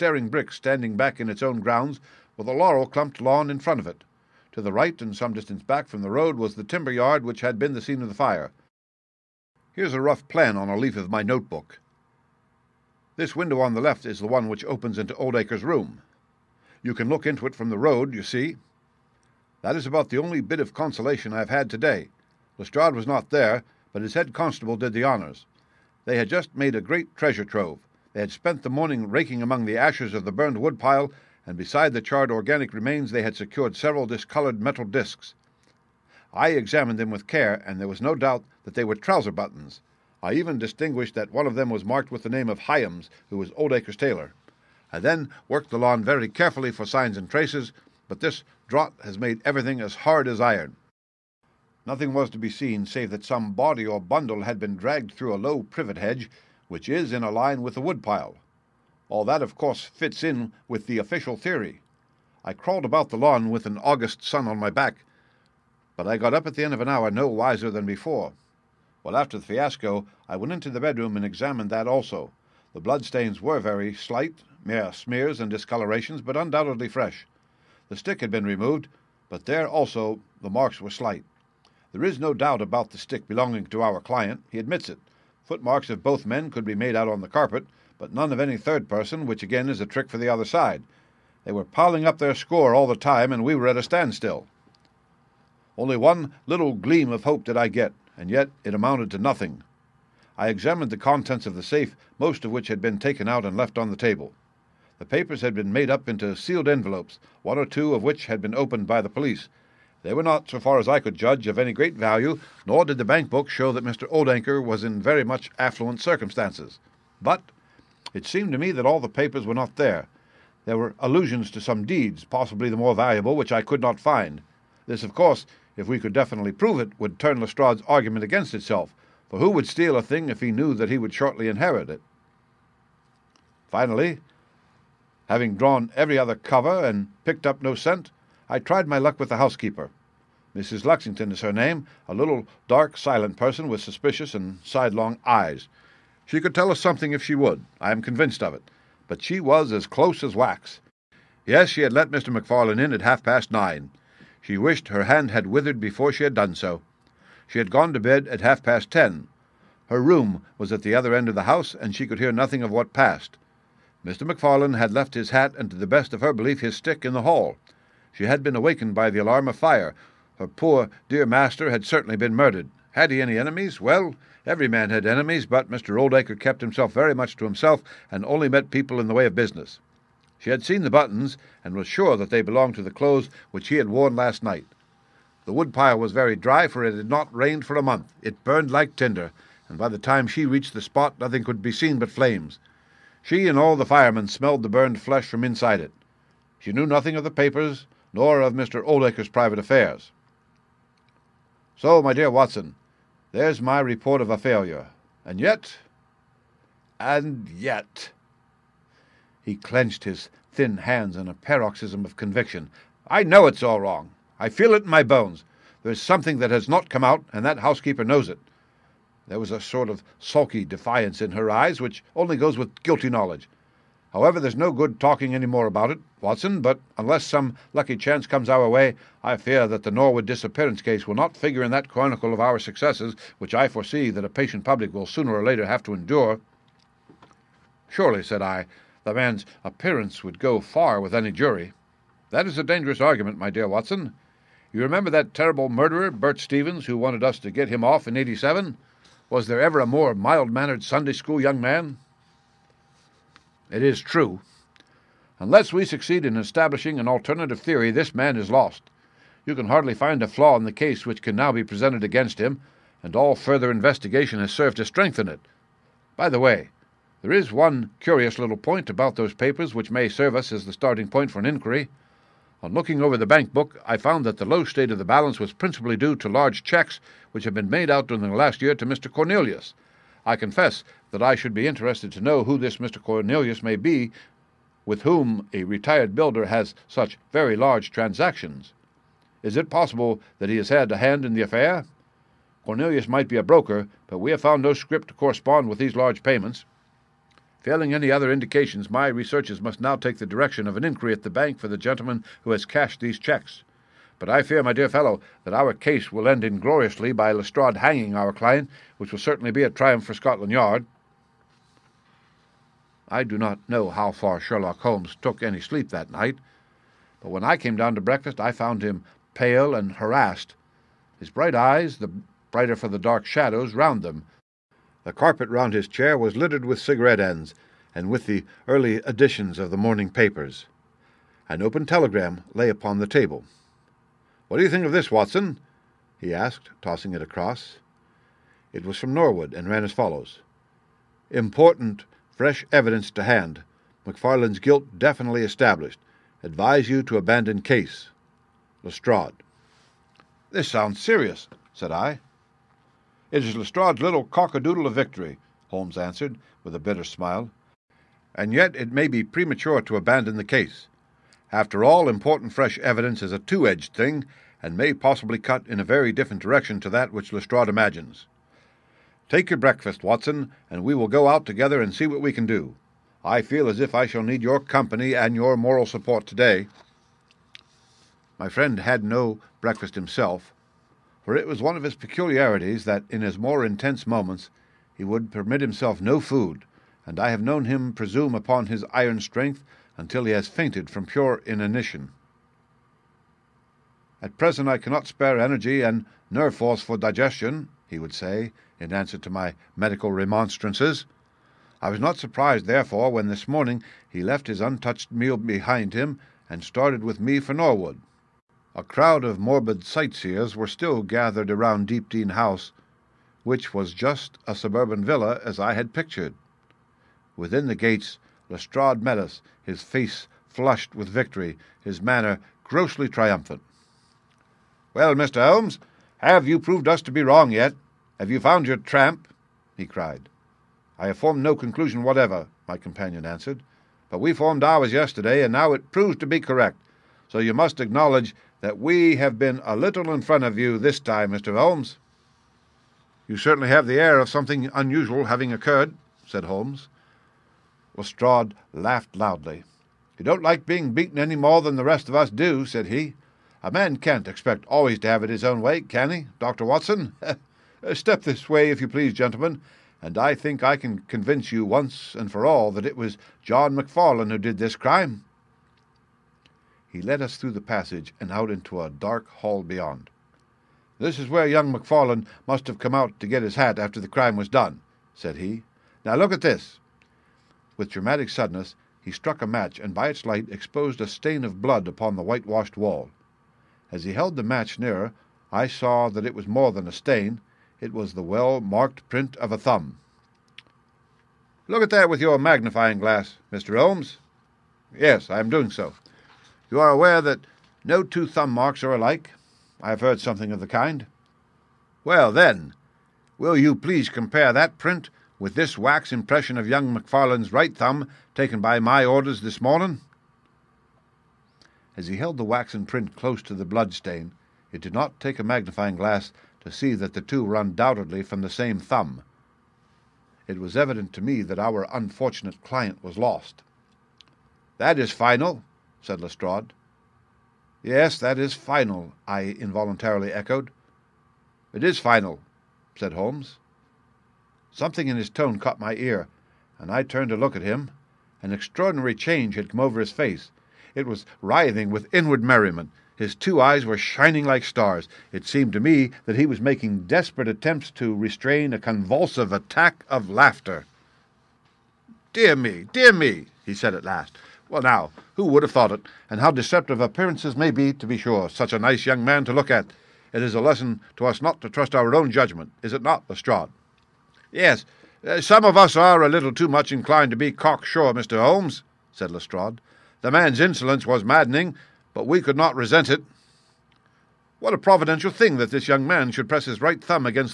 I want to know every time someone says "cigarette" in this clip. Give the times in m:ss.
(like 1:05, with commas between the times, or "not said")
5:26.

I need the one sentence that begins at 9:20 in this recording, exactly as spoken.
It is a lesson to us not to trust our own judgment, is it not, Lestrade?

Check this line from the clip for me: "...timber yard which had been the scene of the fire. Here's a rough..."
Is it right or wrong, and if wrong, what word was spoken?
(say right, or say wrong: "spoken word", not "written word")
right.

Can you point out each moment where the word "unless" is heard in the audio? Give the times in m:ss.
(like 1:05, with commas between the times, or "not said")
3:46, 4:15.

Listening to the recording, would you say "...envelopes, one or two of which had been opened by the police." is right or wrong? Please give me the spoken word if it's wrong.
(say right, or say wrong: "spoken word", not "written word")
right.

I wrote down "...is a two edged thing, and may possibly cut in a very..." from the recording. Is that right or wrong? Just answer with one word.
right.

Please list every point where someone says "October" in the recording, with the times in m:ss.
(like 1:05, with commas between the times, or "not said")
not said.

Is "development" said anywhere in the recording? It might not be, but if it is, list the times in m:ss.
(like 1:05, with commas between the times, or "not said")
not said.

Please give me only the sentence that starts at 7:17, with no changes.
So you must acknowledge that we have been a little in front of you this time, Mr.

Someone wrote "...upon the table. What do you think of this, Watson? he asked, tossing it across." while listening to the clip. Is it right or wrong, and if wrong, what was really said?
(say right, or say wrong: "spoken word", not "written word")
right.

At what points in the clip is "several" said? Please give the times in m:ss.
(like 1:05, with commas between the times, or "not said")
0:33.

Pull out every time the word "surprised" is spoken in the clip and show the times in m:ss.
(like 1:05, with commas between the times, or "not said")
6:42.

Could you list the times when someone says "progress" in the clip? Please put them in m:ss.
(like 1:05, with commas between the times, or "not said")
not said.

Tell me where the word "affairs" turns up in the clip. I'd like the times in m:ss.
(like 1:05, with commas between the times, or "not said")
3:19, 4:51.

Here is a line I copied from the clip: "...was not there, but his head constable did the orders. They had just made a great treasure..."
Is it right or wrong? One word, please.
wrong.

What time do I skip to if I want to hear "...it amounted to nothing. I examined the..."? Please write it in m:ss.
1:38.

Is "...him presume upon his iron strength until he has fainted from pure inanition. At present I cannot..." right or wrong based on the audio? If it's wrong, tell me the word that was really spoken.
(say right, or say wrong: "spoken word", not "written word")
right.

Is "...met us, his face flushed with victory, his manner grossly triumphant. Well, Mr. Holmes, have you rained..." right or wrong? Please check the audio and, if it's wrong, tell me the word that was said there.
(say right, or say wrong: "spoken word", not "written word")
wrong: "proved", not "rained".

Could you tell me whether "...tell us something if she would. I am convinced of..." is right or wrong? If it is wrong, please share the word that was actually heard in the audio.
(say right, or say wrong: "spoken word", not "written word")
right.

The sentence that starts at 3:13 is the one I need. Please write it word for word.
She and all the firemen smelled the burned flesh from inside it.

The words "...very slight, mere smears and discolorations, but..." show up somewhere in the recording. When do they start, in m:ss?
1:13.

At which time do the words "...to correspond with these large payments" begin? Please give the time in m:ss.
4:55.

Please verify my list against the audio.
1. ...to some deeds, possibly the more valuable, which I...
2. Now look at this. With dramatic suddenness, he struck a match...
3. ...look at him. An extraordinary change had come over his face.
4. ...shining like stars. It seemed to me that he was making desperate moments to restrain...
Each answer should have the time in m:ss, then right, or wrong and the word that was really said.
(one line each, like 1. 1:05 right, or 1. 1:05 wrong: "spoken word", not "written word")
1. 2:01 right
2. 7:56 right
3. 8:57 right
4. 9:03 wrong: "attempts", not "moments".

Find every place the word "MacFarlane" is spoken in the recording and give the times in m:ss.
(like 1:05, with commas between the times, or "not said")
2:32, 2:44, 5:44, 7:43, 7:51, 8:26.